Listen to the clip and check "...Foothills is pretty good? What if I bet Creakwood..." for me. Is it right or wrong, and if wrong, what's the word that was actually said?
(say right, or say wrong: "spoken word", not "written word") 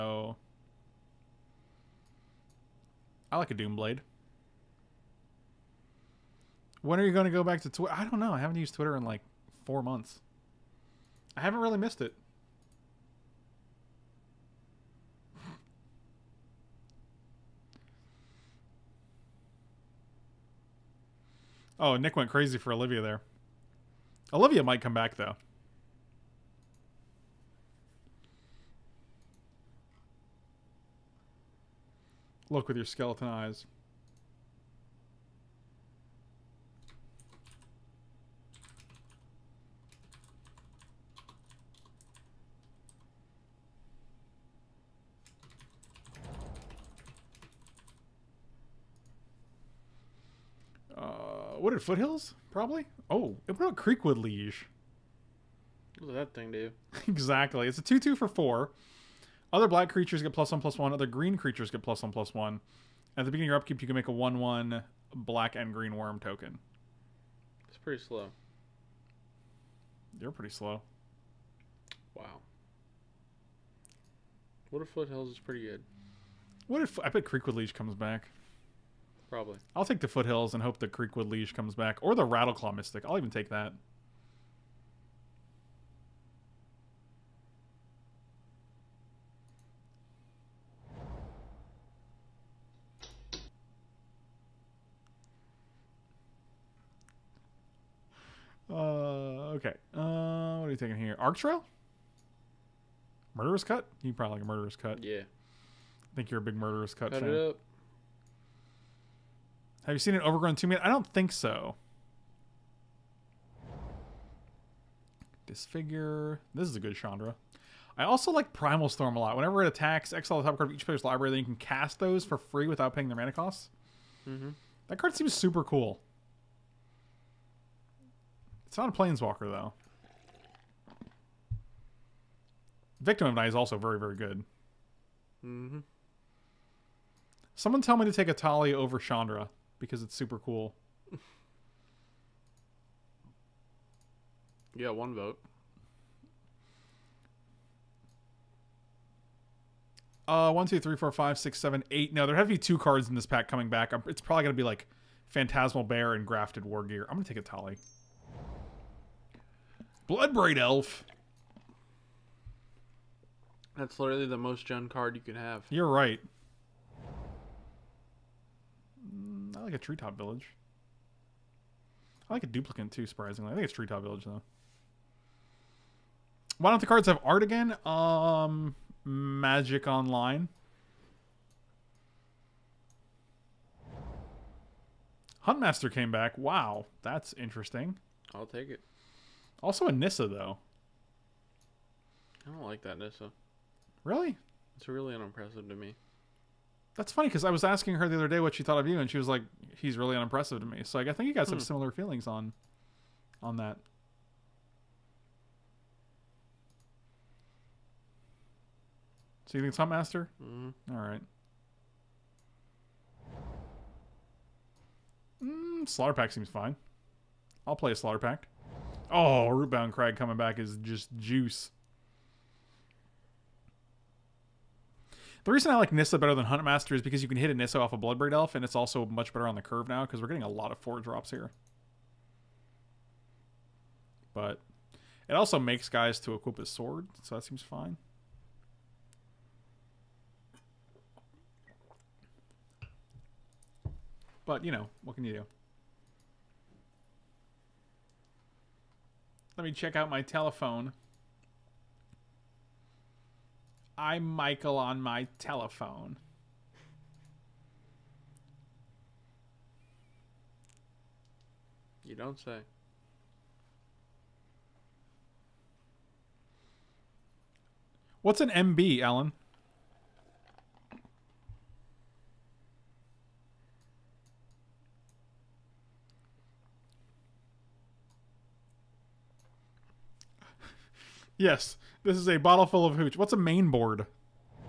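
right.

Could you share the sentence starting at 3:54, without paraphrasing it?
But it also makes guys to equip his sword, so that seems fine.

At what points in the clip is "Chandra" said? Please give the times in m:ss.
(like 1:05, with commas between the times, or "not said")
1:56, 2:18.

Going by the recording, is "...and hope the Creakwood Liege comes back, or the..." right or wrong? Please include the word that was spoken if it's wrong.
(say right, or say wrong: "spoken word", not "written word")
right.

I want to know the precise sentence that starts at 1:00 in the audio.
Other green creatures get plus 1 plus 1.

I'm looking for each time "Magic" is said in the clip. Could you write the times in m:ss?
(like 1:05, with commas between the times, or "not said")
2:59.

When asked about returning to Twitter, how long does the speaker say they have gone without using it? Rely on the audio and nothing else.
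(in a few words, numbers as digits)
4 months.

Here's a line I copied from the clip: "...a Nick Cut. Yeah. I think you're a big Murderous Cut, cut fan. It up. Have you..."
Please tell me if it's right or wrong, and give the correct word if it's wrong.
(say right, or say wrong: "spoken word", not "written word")
wrong: "Murderous", not "Nick".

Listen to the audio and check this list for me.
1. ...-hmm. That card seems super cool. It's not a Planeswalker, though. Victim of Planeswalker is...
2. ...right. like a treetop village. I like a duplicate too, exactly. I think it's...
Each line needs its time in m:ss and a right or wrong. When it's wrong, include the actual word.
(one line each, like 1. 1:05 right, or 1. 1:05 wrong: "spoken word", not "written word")
1. 2:04 wrong: "Night", not "Planeswalker"
2. 2:45 wrong: "surprisingly", not "exactly".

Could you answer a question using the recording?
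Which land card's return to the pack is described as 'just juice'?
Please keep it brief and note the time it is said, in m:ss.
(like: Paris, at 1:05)
Rootbound Crag, at 3:39.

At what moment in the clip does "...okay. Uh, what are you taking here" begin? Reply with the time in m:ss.
1:39.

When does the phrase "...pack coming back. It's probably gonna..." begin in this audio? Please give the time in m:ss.
2:33.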